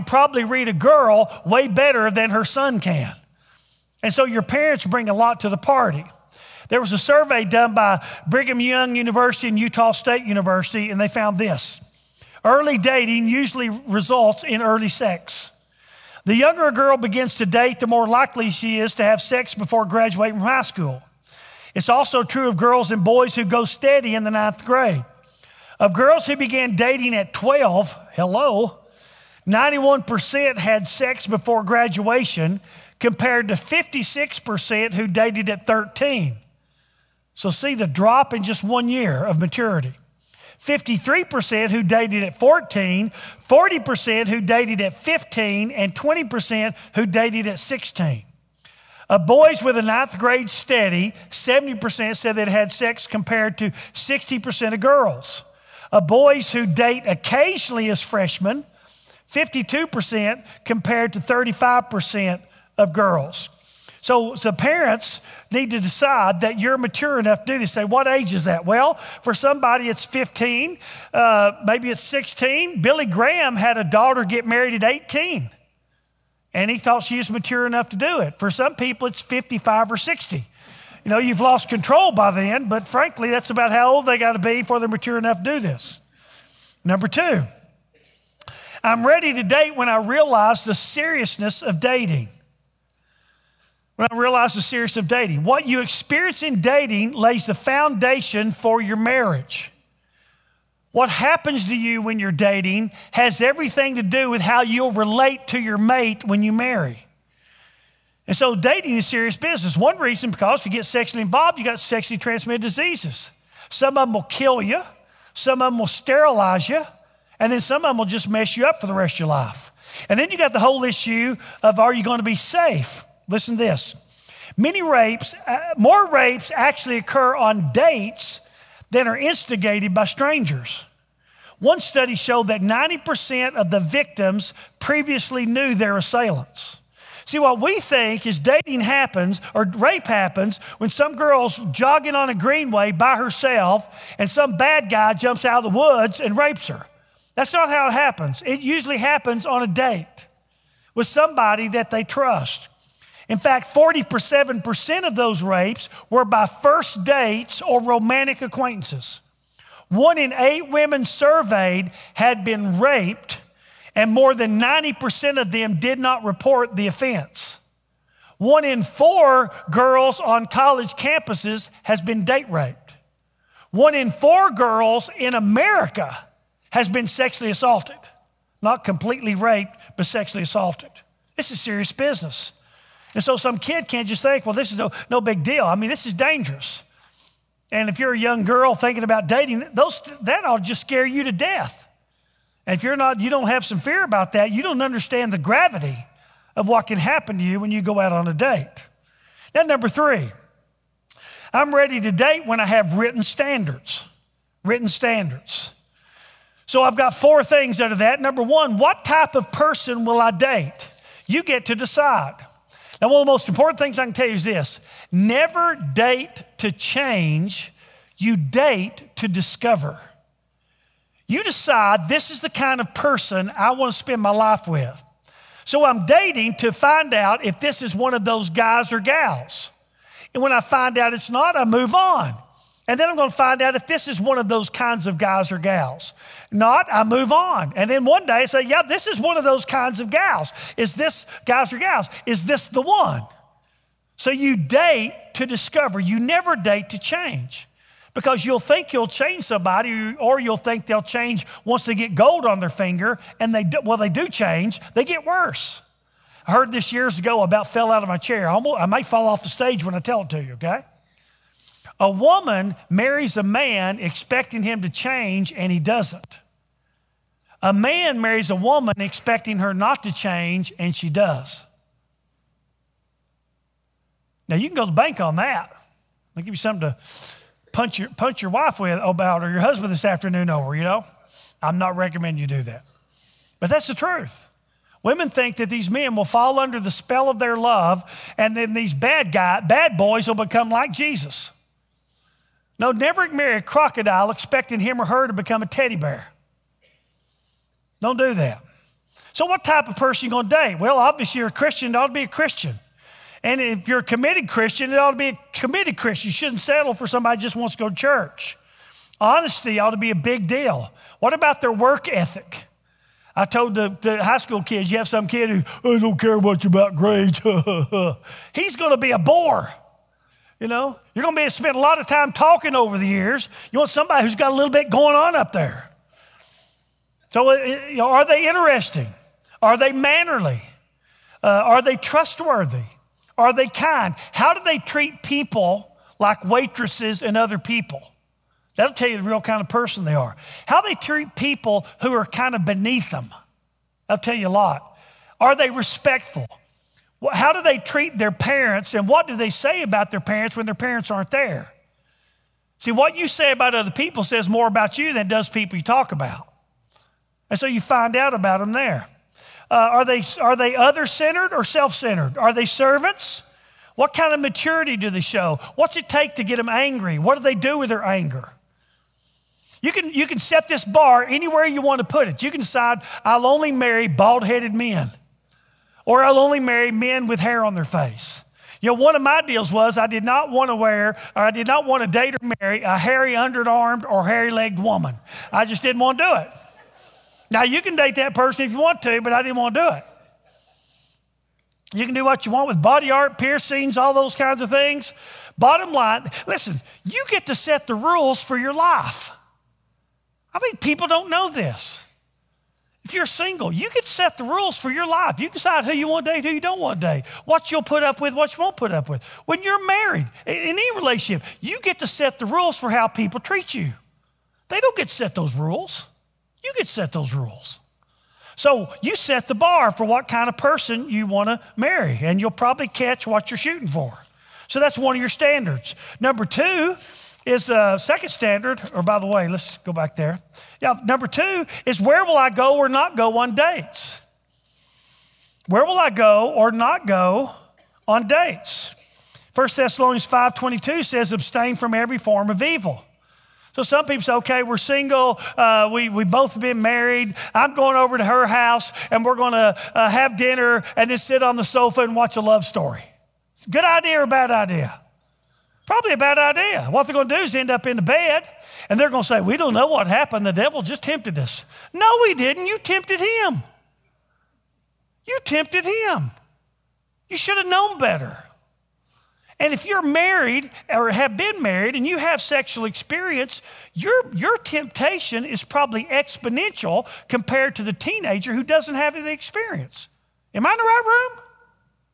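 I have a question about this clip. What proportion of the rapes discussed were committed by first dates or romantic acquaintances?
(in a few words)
47%.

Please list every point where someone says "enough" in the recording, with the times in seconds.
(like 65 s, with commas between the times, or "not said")
67 s, 77 s, 85 s.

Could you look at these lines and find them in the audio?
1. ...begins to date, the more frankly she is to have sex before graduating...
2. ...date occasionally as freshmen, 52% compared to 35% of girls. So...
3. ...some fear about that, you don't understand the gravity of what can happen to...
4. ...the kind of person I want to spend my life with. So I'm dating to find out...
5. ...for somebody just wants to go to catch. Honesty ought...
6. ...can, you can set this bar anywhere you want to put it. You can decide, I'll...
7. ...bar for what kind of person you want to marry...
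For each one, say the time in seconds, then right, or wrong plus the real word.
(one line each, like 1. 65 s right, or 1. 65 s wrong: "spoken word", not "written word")
1. 16 s wrong: "likely", not "frankly"
2. 56 s right
3. 193 s right
4. 222 s right
5. 306 s wrong: "church", not "catch"
6. 369 s right
7. 419 s right.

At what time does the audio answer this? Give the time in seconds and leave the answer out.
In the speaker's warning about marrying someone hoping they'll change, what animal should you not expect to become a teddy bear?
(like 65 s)
293 s.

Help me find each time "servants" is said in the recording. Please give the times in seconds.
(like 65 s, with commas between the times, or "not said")
362 s.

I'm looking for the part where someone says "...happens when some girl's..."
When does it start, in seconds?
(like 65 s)
140 s.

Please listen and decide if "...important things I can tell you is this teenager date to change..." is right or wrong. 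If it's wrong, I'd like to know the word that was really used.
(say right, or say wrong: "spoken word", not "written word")
wrong: "never", not "teenager".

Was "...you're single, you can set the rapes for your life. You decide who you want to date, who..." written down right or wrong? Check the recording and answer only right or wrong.
wrong.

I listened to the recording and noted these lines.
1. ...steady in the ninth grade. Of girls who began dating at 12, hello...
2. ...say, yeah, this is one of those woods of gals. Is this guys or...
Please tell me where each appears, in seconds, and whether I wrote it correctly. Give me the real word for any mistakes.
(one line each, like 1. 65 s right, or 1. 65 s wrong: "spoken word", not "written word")
1. 23 s right
2. 238 s wrong: "kinds", not "woods".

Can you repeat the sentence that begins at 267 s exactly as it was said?
A man marries a woman expecting her not to change, and she does.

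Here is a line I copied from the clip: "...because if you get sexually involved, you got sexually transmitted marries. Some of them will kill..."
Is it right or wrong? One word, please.
wrong.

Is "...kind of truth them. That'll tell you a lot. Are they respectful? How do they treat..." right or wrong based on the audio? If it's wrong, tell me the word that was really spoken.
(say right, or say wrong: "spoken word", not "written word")
wrong: "beneath", not "truth".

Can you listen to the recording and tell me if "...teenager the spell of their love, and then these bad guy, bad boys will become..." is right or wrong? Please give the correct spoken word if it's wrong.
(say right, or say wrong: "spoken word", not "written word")
wrong: "under", not "teenager".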